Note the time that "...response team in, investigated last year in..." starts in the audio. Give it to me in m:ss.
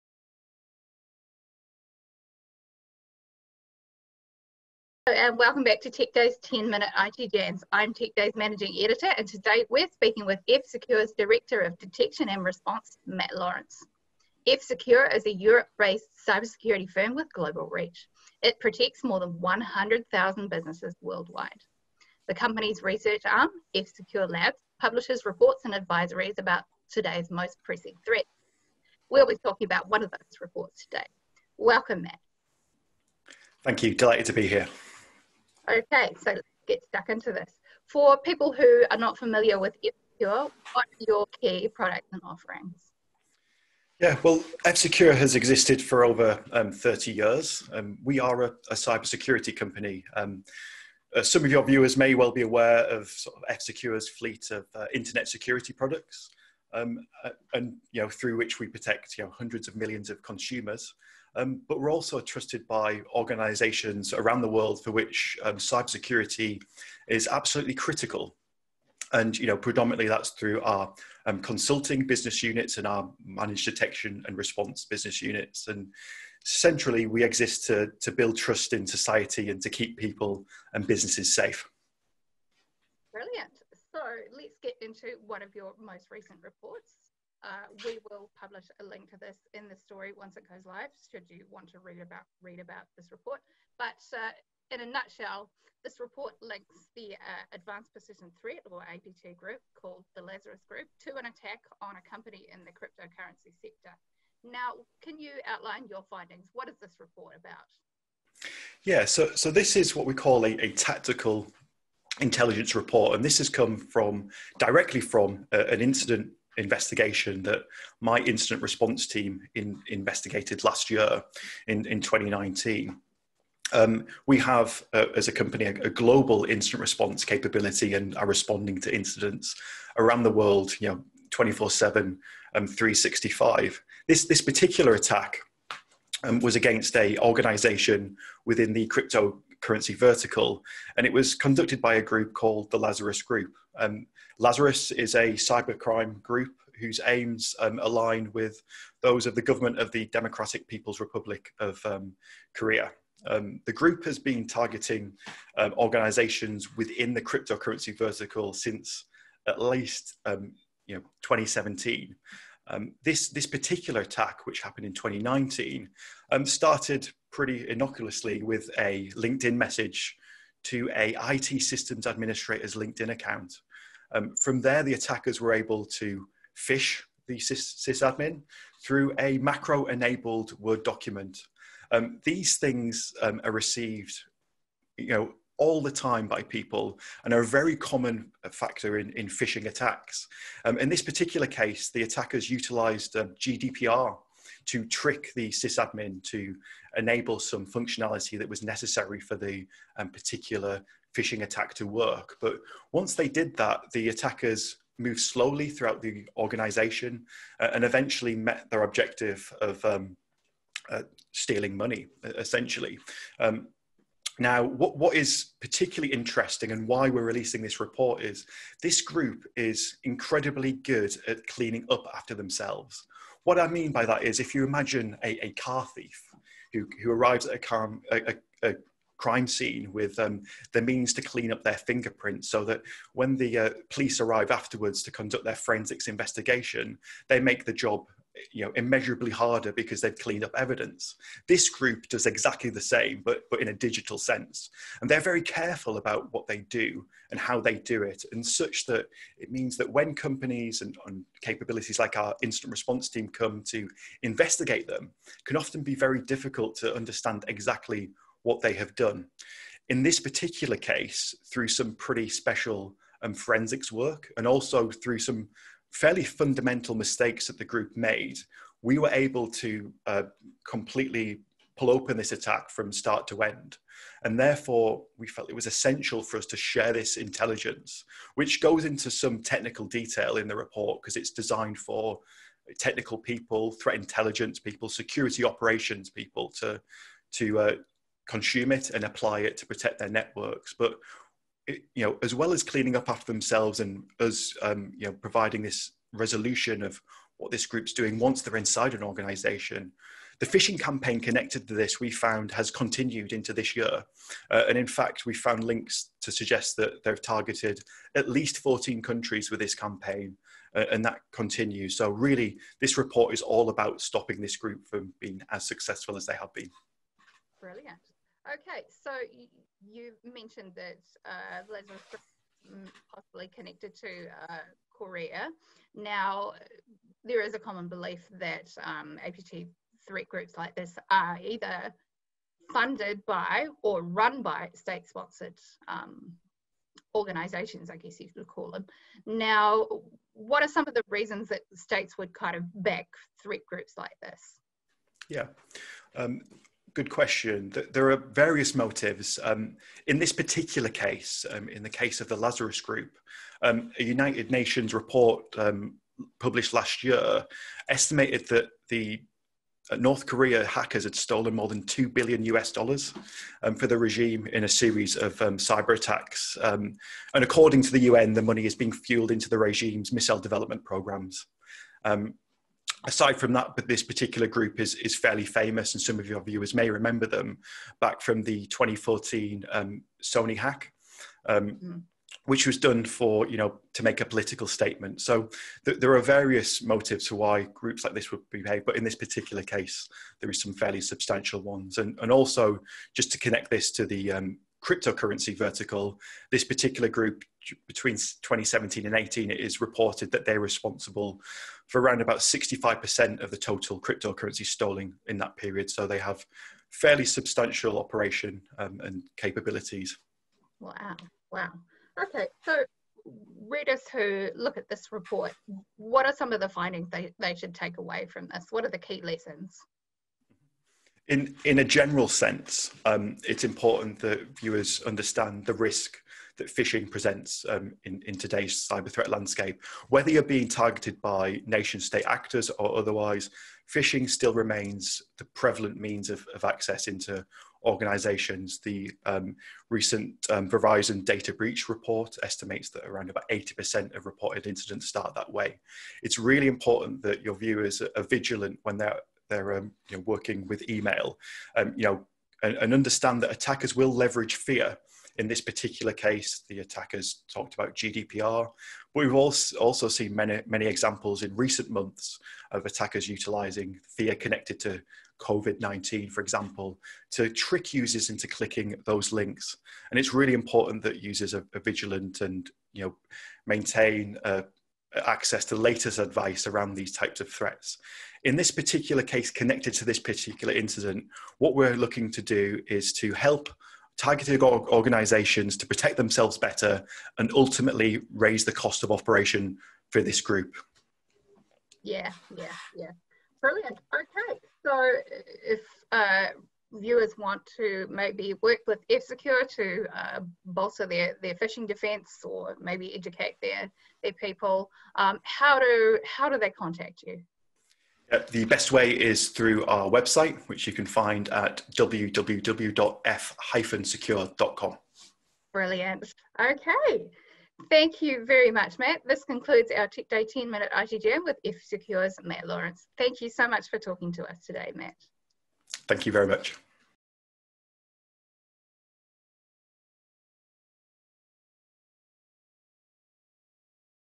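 1:58.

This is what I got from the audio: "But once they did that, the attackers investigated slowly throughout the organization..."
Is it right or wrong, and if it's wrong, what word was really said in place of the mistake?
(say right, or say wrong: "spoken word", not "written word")
wrong: "moved", not "investigated".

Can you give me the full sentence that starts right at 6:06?
and according to the UN, the money is being fueled into the regime's missile development programs.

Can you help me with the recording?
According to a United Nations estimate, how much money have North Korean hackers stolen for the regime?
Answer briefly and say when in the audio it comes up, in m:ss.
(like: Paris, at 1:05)
more than 2 billion US dollars, at 6:01.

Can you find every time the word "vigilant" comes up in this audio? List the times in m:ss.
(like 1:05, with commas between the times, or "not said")
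7:28, 7:51.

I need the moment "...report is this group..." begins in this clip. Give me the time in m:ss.
3:37.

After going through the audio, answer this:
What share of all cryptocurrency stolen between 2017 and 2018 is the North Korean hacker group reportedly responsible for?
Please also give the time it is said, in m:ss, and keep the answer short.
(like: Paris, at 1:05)
65%, at 6:42.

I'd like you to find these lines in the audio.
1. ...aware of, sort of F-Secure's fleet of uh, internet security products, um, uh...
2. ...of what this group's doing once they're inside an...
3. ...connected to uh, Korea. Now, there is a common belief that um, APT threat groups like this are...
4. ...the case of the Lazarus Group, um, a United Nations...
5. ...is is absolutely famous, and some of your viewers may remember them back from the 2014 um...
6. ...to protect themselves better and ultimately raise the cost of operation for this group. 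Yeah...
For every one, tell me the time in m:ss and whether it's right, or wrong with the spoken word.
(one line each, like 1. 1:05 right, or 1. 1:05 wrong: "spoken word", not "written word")
1. 0:52 right
2. 4:56 right
3. 5:23 right
4. 5:51 right
5. 6:14 wrong: "fairly", not "absolutely"
6. 8:05 right.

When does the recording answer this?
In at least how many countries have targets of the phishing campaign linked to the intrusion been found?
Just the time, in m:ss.
5:08.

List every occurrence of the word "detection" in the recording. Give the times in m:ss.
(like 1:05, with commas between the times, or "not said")
0:11, 1:13.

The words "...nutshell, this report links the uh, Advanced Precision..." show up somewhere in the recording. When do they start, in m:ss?
1:34.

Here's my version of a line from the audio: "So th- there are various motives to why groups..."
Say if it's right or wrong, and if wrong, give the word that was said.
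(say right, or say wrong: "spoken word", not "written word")
right.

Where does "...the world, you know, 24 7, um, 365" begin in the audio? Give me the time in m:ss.
2:10.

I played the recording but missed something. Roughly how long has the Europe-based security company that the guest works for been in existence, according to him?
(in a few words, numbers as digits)
over 30 years.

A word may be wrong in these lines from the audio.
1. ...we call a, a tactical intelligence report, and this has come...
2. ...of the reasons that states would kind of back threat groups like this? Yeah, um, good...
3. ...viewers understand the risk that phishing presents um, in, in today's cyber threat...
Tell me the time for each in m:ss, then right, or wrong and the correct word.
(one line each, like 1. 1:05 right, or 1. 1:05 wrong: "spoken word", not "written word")
1. 1:50 right
2. 5:40 right
3. 7:04 right.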